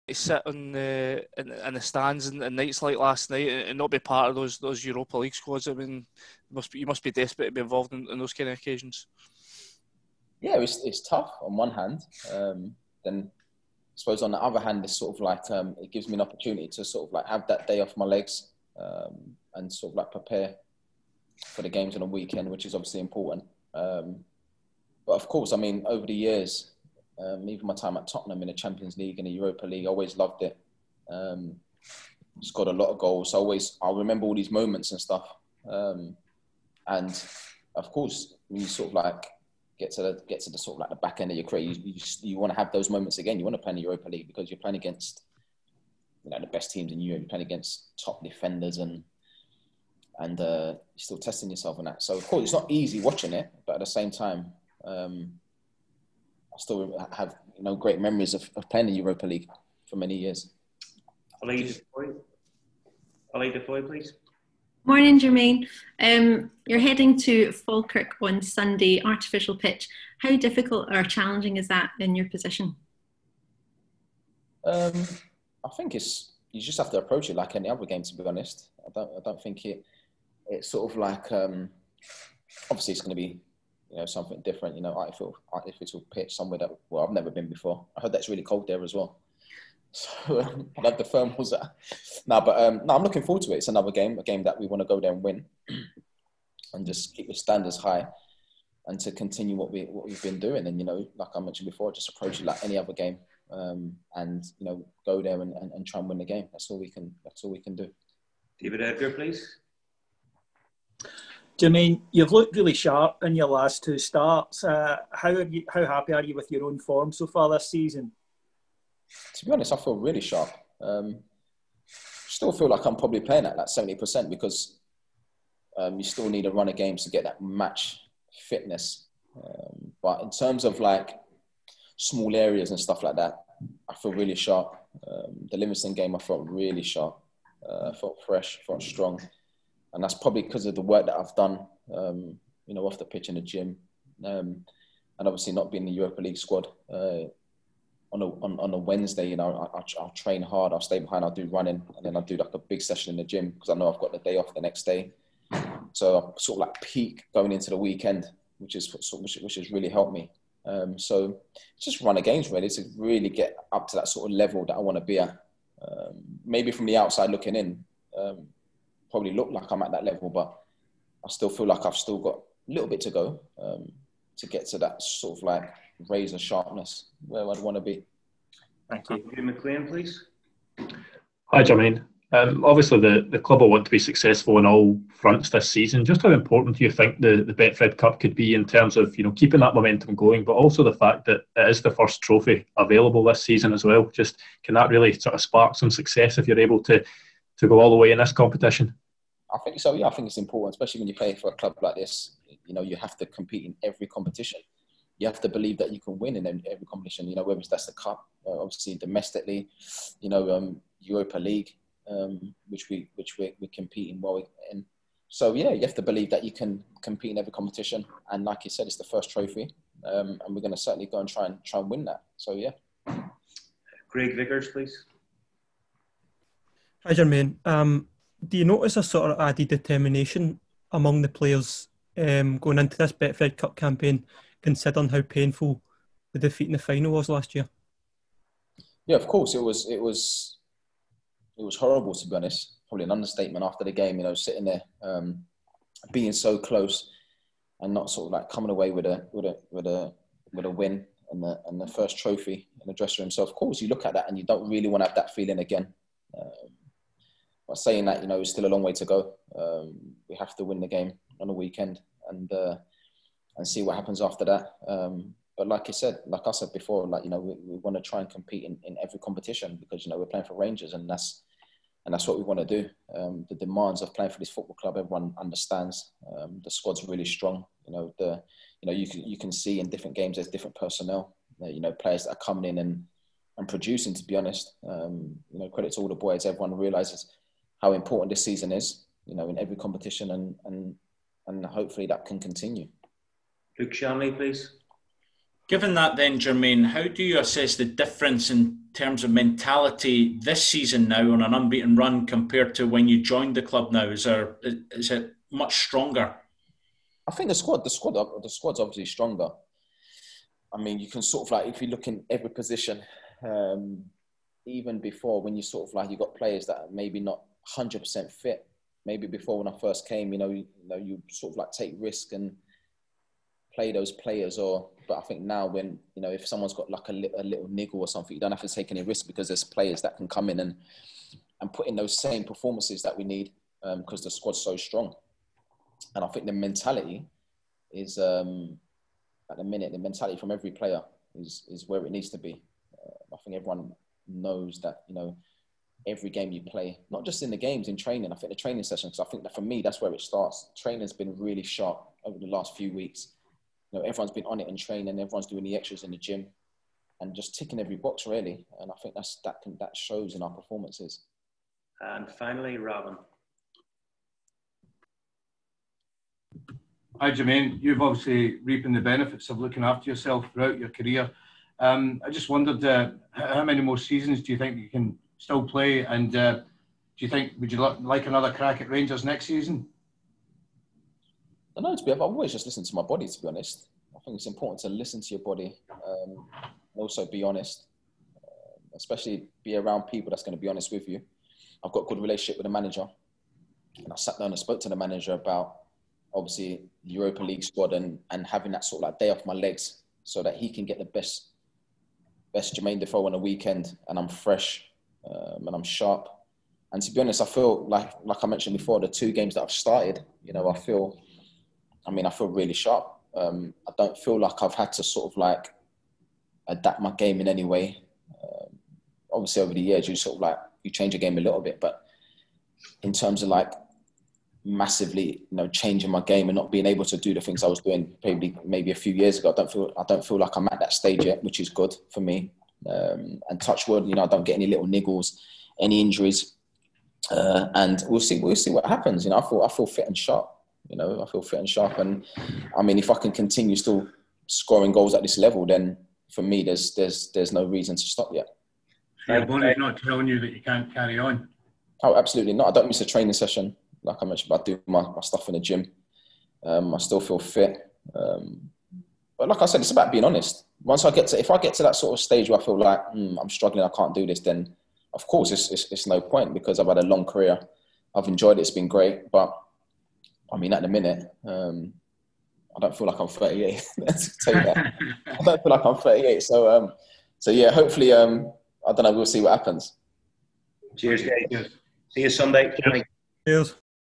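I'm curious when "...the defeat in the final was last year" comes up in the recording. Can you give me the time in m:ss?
3:56.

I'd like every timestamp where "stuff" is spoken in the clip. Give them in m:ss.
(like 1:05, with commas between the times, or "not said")
0:34, 2:12, 7:35.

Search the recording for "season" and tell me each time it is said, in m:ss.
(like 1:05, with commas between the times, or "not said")
1:57, 3:05, 3:13, 4:48, 5:00, 6:13, 6:19.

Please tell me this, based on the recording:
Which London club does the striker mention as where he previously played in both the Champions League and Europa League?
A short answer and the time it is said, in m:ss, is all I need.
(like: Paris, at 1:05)
Tottenham, at 0:28.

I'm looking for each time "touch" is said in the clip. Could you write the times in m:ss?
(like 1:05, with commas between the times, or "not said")
7:13.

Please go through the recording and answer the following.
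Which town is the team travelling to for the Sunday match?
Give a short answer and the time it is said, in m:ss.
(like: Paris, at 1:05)
Falkirk, at 1:07.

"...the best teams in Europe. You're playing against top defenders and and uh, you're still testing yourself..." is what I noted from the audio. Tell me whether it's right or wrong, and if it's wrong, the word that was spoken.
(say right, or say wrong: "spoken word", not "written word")
right.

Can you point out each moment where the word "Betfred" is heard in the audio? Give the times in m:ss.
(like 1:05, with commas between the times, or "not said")
3:07, 3:53.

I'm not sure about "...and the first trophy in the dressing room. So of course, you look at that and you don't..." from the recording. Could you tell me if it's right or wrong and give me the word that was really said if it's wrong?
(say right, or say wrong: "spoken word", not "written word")
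right.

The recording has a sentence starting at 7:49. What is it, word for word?
But I mean, at the minute, um, I don't feel like I'm 38.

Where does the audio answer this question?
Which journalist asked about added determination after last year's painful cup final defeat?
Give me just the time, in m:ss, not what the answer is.
3:44.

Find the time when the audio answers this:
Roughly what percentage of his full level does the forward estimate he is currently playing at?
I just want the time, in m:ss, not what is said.
2:03.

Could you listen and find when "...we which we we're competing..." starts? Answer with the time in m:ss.
3:32.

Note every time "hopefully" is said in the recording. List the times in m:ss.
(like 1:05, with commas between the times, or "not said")
4:51, 7:57.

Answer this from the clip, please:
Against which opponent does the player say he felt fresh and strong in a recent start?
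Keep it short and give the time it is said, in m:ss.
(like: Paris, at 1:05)
Livingston, at 2:15.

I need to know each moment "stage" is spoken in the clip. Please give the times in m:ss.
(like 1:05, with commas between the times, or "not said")
7:10, 7:42.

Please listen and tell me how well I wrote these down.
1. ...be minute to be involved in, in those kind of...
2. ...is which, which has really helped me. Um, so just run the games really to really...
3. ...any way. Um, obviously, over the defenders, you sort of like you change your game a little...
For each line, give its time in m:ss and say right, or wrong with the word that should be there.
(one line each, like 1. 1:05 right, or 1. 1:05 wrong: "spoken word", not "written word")
1. 0:07 wrong: "desperate", not "minute"
2. 2:38 right
3. 6:57 wrong: "years", not "defenders".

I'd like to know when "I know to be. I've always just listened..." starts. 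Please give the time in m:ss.
6:21.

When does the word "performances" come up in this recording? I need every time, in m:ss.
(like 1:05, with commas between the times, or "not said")
5:32, 6:00.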